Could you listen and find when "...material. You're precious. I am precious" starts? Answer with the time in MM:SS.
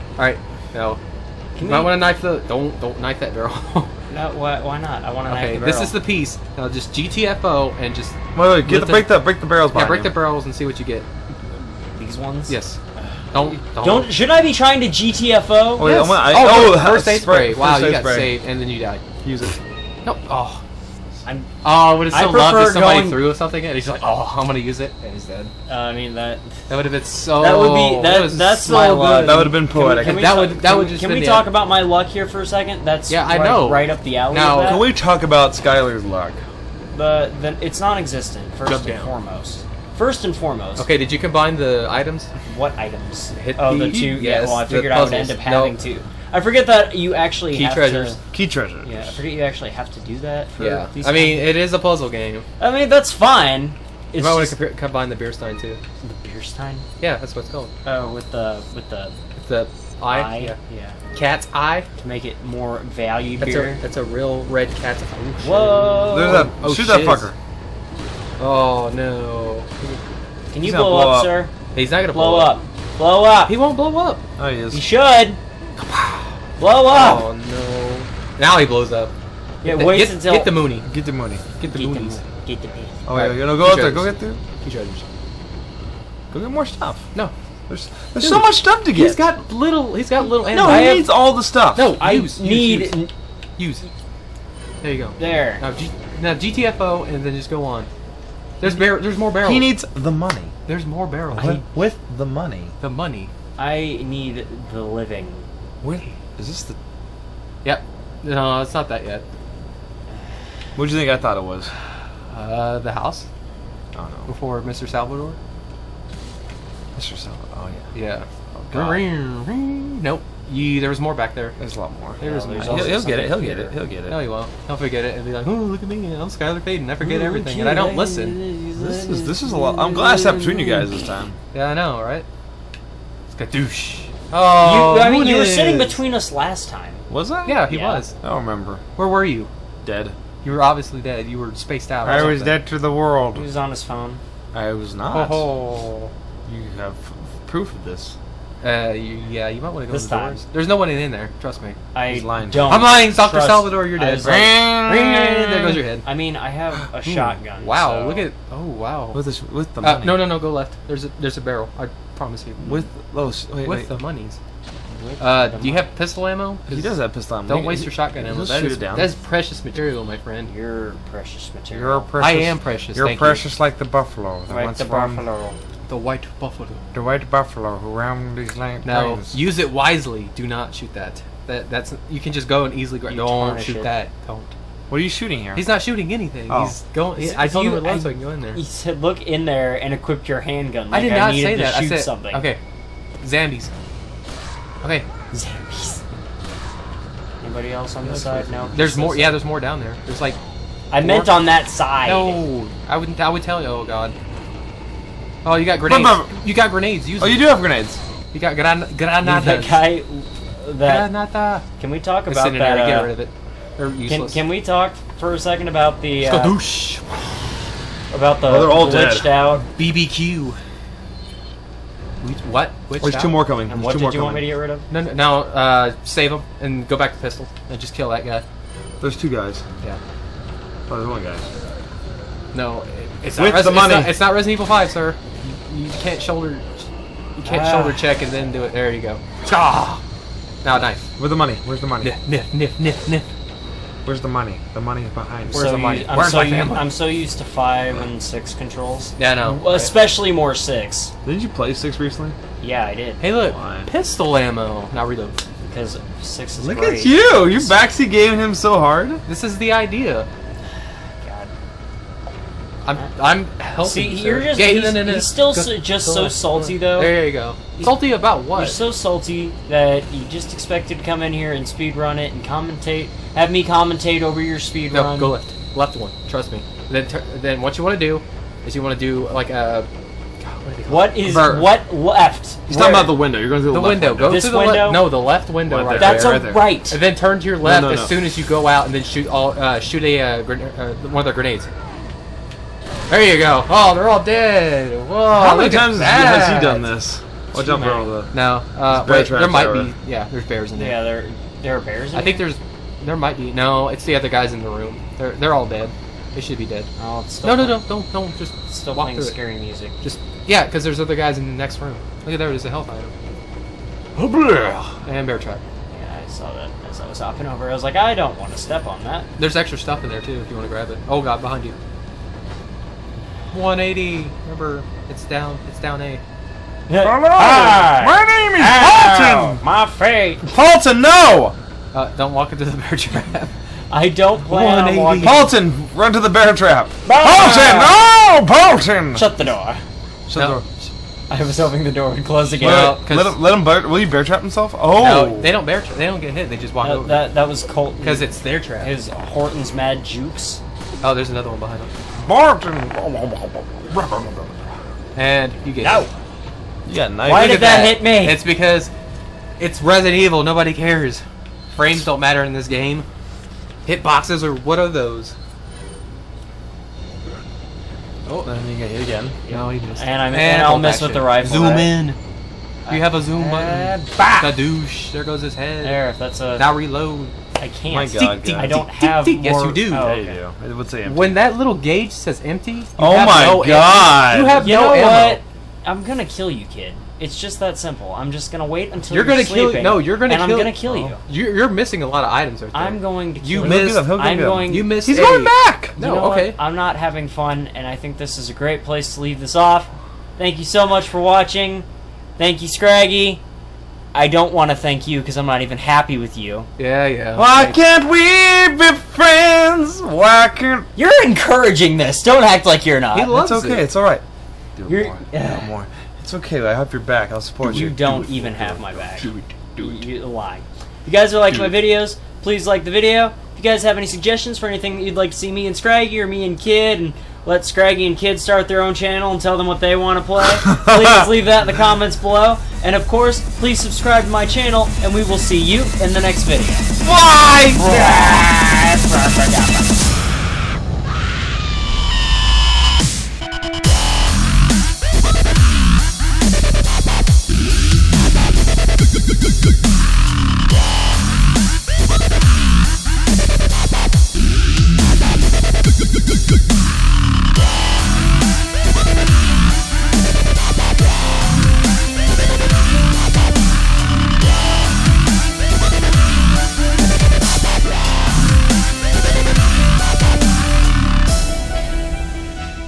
02:51.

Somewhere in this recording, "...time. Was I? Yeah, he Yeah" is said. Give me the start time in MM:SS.
02:16.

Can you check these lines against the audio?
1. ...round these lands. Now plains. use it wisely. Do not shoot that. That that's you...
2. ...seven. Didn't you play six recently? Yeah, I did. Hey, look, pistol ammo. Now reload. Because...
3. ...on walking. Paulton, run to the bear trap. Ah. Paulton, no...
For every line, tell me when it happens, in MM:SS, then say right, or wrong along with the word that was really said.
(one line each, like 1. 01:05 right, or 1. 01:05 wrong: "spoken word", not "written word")
1. 02:57 right
2. 04:10 wrong: "six", not "seven"
3. 05:34 right.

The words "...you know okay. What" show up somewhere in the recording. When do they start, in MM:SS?
06:36.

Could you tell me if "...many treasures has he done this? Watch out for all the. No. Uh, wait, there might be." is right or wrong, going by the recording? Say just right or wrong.
wrong.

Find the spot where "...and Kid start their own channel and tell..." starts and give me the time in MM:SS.
07:08.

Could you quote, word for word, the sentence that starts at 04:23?
See, you're just he's, he's still so, just so salty though.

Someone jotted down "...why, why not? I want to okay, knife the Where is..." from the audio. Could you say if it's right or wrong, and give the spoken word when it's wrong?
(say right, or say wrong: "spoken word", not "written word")
wrong: "This", not "Where".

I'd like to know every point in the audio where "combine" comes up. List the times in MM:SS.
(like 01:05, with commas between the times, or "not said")
00:41, 00:54.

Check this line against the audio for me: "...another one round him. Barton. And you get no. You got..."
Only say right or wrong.
wrong.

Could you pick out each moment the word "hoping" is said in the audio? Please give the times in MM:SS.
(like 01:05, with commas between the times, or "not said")
05:41.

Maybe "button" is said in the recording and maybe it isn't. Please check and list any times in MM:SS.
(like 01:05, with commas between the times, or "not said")
06:13.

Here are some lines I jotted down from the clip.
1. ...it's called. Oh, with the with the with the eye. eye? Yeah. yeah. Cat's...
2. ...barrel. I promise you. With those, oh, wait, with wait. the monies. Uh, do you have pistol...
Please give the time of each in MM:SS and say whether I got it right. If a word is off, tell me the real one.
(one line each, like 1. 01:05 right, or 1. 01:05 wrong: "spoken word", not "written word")
1. 00:57 right
2. 02:41 right.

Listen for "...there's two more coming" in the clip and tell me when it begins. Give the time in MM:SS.
03:43.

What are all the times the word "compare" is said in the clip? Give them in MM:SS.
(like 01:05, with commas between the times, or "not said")
00:54.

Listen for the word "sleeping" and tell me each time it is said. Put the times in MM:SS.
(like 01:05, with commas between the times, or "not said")
06:29.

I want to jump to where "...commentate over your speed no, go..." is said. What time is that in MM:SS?
04:33.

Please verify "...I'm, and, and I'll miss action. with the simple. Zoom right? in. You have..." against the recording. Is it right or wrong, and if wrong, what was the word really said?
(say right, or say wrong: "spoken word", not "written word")
wrong: "rifle", not "simple".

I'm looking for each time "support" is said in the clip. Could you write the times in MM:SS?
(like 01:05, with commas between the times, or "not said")
06:57.